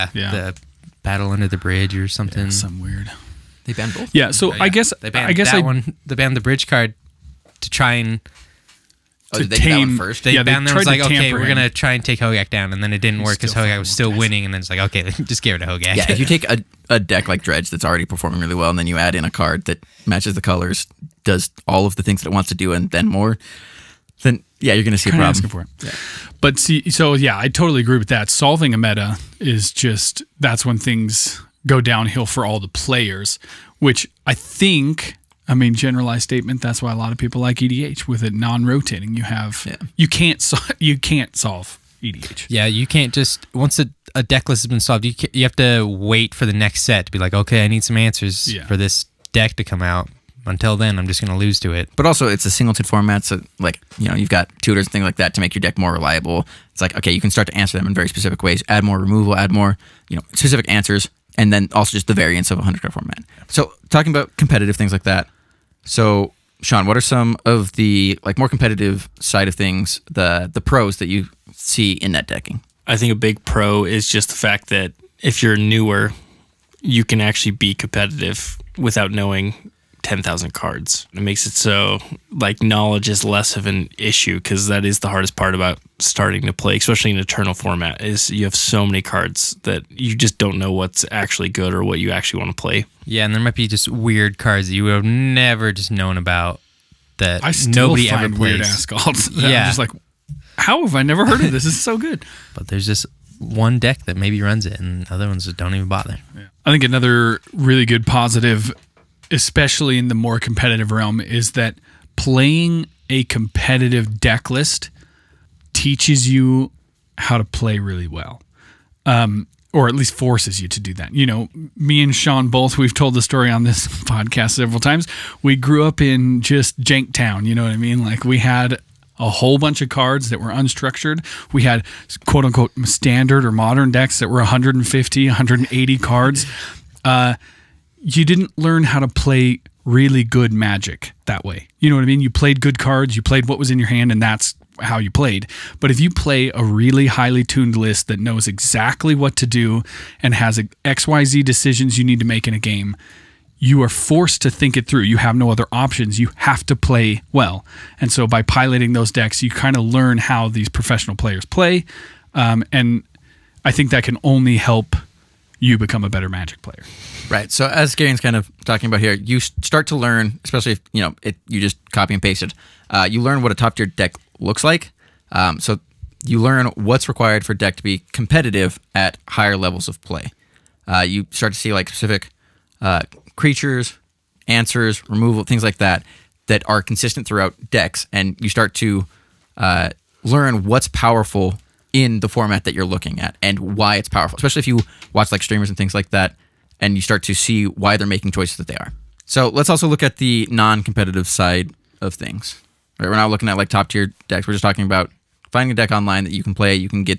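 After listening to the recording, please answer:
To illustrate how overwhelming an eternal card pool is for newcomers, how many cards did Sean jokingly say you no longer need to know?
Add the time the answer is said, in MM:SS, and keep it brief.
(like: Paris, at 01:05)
10,000, at 01:20.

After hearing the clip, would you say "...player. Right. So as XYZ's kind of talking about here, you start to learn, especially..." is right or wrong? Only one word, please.
wrong.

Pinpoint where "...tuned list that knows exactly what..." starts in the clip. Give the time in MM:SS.
02:27.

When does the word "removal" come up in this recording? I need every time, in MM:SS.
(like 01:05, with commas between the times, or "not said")
00:58, 03:05.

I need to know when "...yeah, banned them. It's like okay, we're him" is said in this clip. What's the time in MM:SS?
00:10.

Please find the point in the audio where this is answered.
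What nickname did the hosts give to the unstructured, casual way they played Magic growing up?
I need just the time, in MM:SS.
02:06.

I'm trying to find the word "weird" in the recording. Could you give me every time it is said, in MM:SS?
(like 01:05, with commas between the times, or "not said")
00:02, 01:33, 01:38.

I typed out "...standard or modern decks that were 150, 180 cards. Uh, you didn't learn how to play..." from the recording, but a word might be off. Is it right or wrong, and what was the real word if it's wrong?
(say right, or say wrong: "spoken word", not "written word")
right.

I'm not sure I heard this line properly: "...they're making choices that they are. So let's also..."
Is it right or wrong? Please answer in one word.
right.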